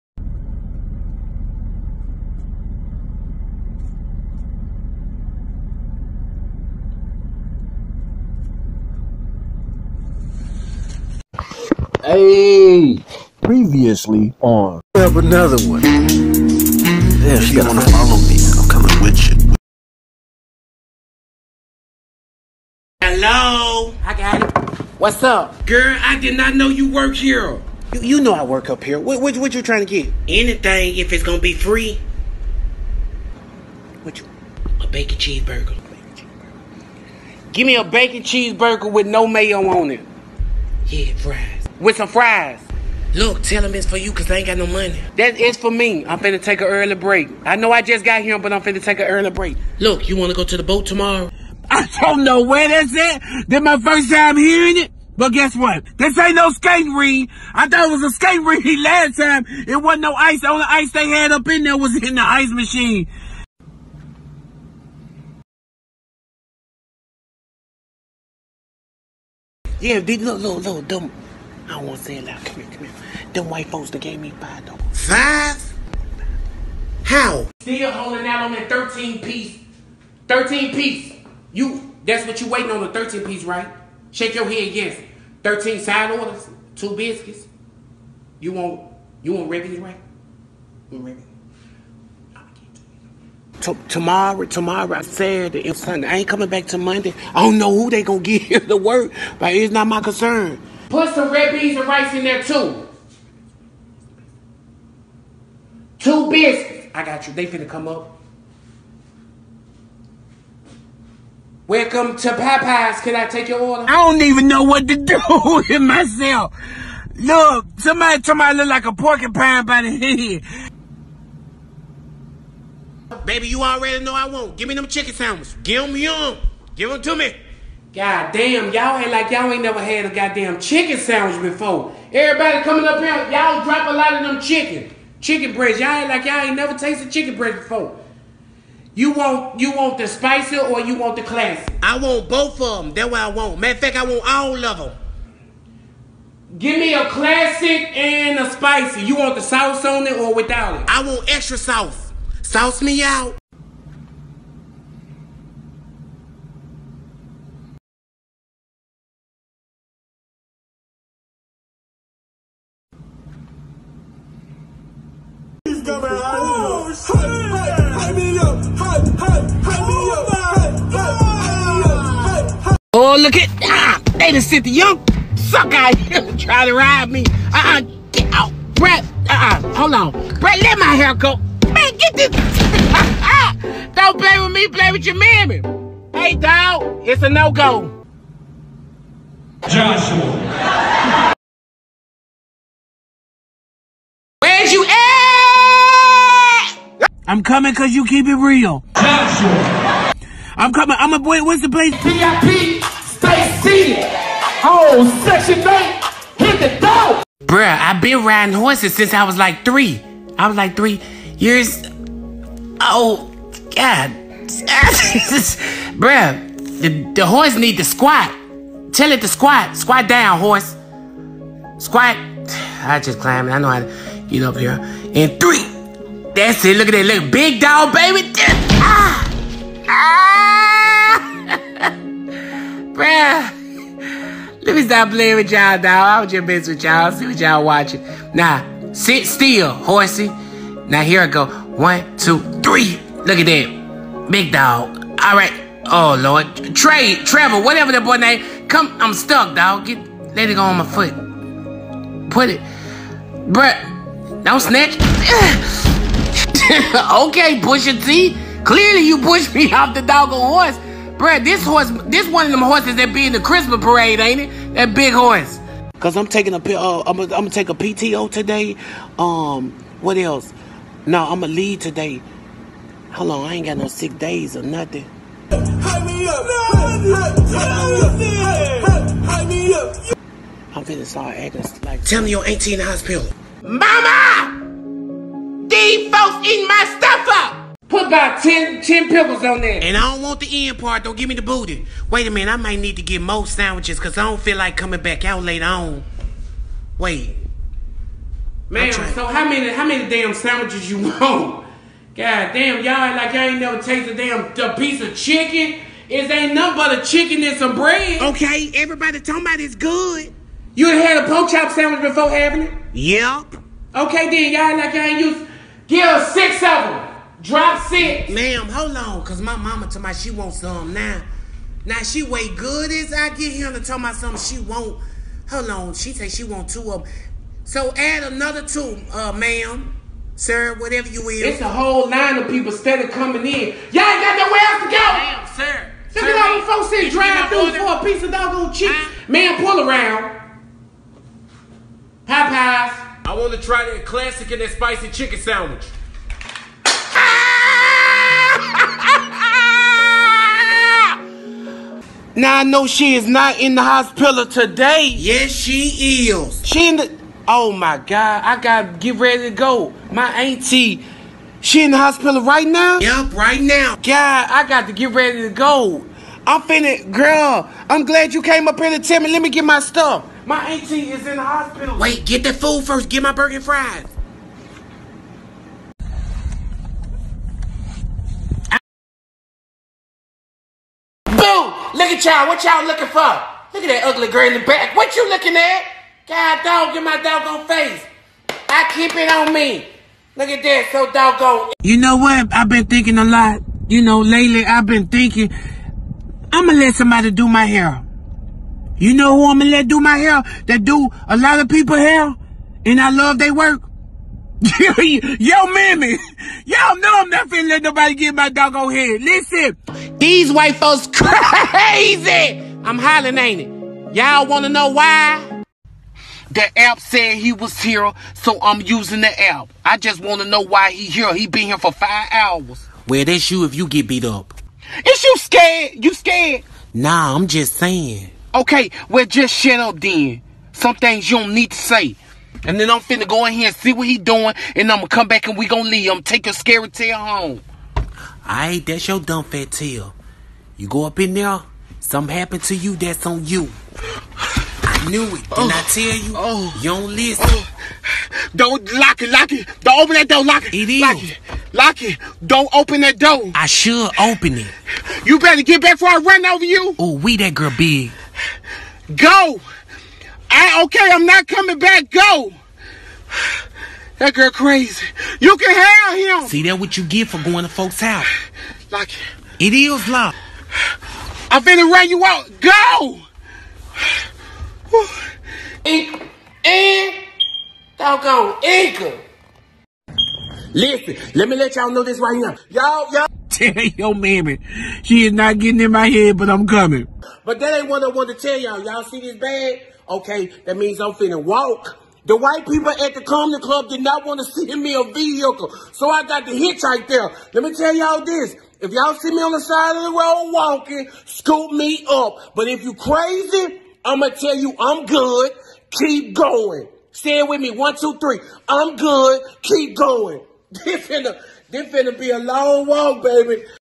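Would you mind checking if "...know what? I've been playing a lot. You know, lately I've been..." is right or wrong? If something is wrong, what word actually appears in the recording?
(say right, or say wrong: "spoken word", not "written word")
wrong: "thinking", not "playing".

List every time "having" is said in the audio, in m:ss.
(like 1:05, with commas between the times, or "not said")
5:12.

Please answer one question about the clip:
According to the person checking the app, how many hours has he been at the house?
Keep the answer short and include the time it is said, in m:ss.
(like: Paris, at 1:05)
5 hours, at 7:01.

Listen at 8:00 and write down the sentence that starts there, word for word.
Listen, let me let y'all know this right now.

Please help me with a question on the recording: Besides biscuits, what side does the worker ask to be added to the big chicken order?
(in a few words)
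Red beans and rice.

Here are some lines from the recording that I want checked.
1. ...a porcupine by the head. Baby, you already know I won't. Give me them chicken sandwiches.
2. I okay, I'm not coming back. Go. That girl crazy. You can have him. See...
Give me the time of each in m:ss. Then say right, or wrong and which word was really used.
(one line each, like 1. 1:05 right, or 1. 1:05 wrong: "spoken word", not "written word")
1. 1:58 right
2. 7:40 right.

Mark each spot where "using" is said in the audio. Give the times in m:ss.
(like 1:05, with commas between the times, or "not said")
6:58.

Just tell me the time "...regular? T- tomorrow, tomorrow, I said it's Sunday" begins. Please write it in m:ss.
1:32.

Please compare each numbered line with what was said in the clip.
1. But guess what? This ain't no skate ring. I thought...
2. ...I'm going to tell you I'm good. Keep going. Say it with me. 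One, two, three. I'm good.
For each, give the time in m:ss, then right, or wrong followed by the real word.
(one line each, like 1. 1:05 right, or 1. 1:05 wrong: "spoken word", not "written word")
1. 0:55 right
2. 8:24 right.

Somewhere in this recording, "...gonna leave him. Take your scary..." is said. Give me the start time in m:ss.
7:15.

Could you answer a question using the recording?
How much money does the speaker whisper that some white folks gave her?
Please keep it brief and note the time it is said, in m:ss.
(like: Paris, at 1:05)
5 dollars, at 1:14.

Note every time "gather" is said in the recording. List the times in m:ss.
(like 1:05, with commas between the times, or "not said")
not said.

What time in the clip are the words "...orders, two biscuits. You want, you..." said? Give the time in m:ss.
1:26.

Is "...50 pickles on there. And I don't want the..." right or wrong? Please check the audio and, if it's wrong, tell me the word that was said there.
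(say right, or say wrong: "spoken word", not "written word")
wrong: "10", not "50".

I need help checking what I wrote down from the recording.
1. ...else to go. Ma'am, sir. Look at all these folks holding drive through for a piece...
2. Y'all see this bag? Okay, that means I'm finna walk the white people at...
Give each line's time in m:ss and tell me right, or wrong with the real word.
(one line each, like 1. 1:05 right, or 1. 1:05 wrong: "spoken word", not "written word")
1. 5:34 wrong: "sitting", not "holding"
2. 8:08 right.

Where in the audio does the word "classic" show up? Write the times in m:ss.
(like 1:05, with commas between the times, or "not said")
2:21, 2:27, 5:44.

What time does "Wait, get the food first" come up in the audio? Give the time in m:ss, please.
6:11.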